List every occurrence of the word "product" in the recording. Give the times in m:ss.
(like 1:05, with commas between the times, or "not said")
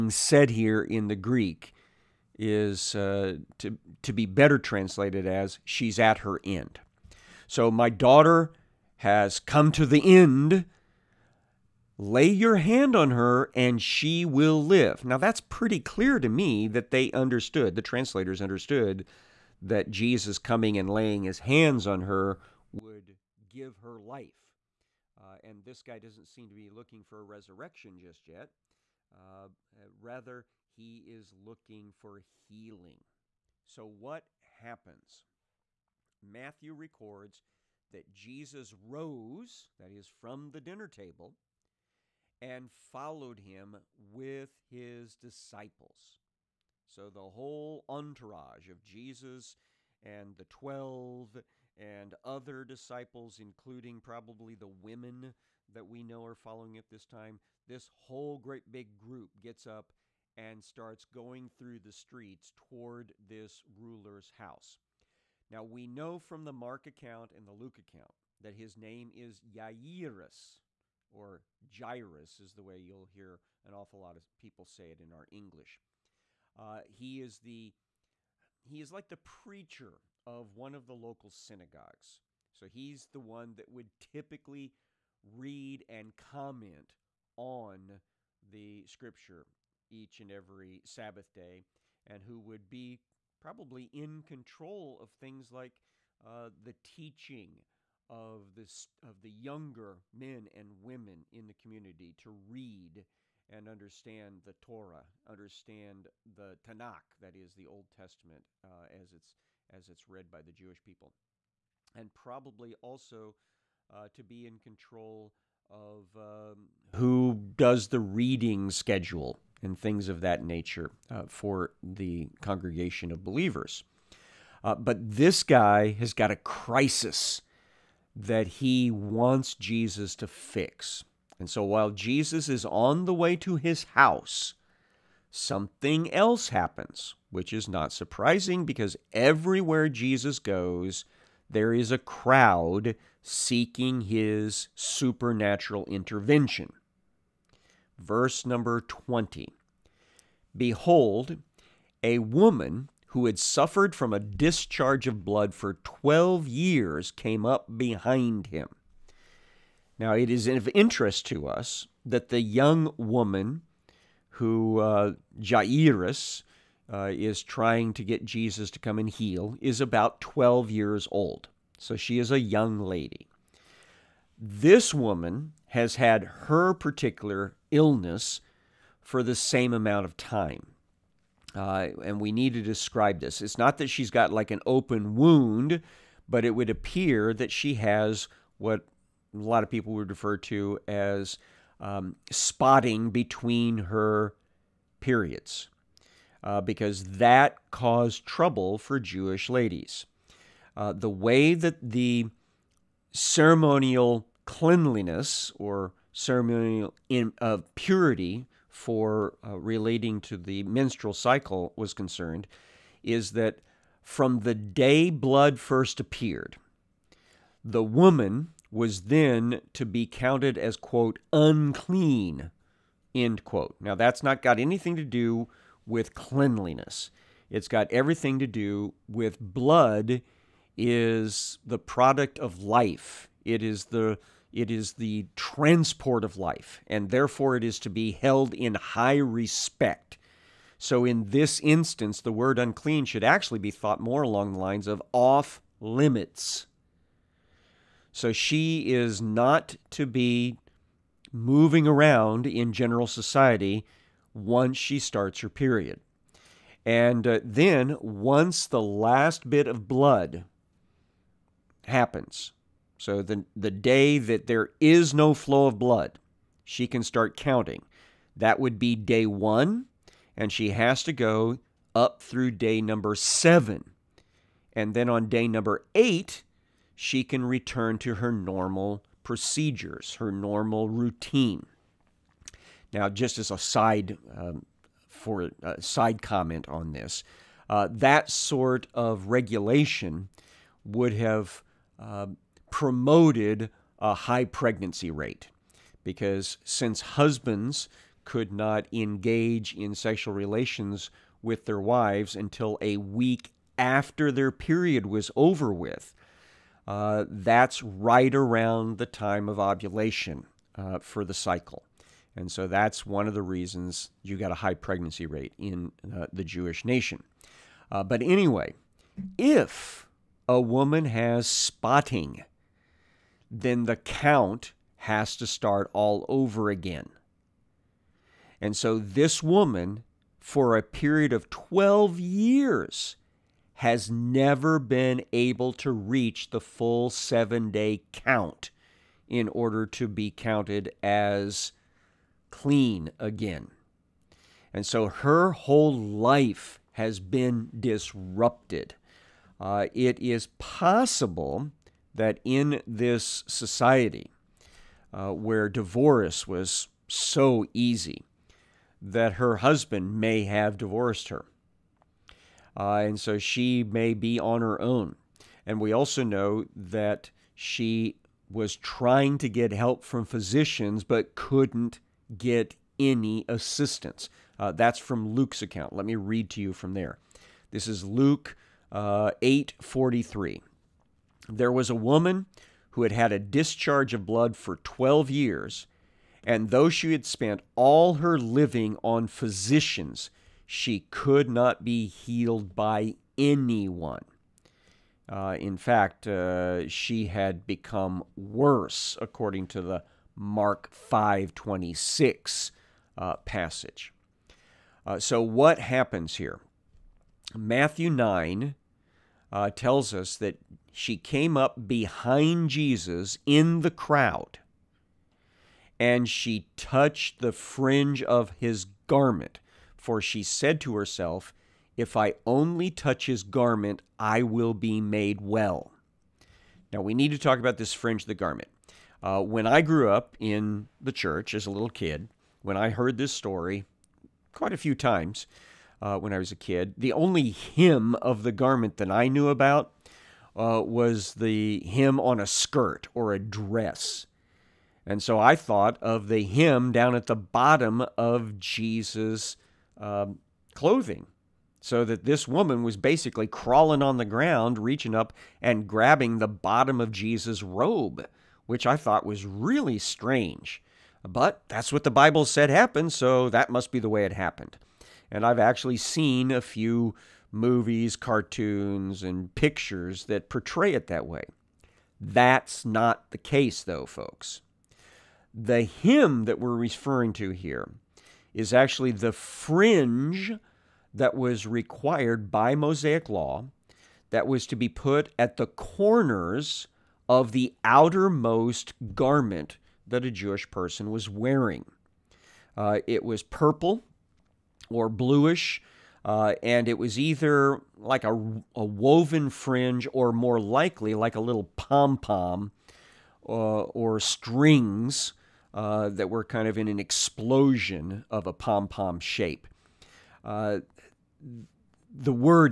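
3:51.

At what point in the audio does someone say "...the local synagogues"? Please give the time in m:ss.
1:20.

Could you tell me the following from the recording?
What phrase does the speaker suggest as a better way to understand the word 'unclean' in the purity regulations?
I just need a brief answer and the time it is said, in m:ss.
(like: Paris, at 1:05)
off limits, at 4:05.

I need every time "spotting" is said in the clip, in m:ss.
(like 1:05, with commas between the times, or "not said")
3:12, 5:21.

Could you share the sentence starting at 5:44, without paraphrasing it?
And so her whole life has been disrupted.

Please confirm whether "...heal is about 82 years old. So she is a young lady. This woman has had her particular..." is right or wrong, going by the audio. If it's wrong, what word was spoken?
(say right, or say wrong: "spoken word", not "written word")
wrong: "12", not "82".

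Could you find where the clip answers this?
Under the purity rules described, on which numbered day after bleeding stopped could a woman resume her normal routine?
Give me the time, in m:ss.
4:35.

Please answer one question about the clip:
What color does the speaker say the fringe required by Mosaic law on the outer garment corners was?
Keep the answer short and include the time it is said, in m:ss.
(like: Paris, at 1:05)
purple or bluish, at 8:13.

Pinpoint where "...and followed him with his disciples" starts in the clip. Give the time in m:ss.
0:42.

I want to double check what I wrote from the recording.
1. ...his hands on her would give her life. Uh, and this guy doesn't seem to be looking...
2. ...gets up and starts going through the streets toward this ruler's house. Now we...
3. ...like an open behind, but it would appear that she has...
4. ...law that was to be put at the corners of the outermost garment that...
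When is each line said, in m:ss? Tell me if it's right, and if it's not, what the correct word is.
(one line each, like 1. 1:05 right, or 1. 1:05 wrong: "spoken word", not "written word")
1. 0:21 right
2. 0:59 right
3. 3:04 wrong: "wound", not "behind"
4. 8:03 right.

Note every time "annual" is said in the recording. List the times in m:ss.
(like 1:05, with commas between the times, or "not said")
not said.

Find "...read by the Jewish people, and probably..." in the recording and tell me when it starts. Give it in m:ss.
1:50.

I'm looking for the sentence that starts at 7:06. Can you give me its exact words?
Now, we need to talk about this fringe of the garment.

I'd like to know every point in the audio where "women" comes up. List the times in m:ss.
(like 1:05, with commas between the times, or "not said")
0:54, 1:40.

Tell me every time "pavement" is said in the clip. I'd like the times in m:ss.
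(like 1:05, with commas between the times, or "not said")
not said.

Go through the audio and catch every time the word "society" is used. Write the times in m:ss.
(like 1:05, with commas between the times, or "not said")
4:13, 5:53.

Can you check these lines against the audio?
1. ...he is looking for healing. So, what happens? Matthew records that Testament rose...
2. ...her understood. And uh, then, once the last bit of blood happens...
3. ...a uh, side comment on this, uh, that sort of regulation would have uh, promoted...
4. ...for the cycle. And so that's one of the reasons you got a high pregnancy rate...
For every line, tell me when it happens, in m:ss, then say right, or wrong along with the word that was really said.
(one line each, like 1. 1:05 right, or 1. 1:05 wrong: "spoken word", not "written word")
1. 0:30 wrong: "Jesus", not "Testament"
2. 4:15 wrong: "period", not "understood"
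3. 4:45 right
4. 5:10 right.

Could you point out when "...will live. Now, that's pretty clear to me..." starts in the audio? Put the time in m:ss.
0:14.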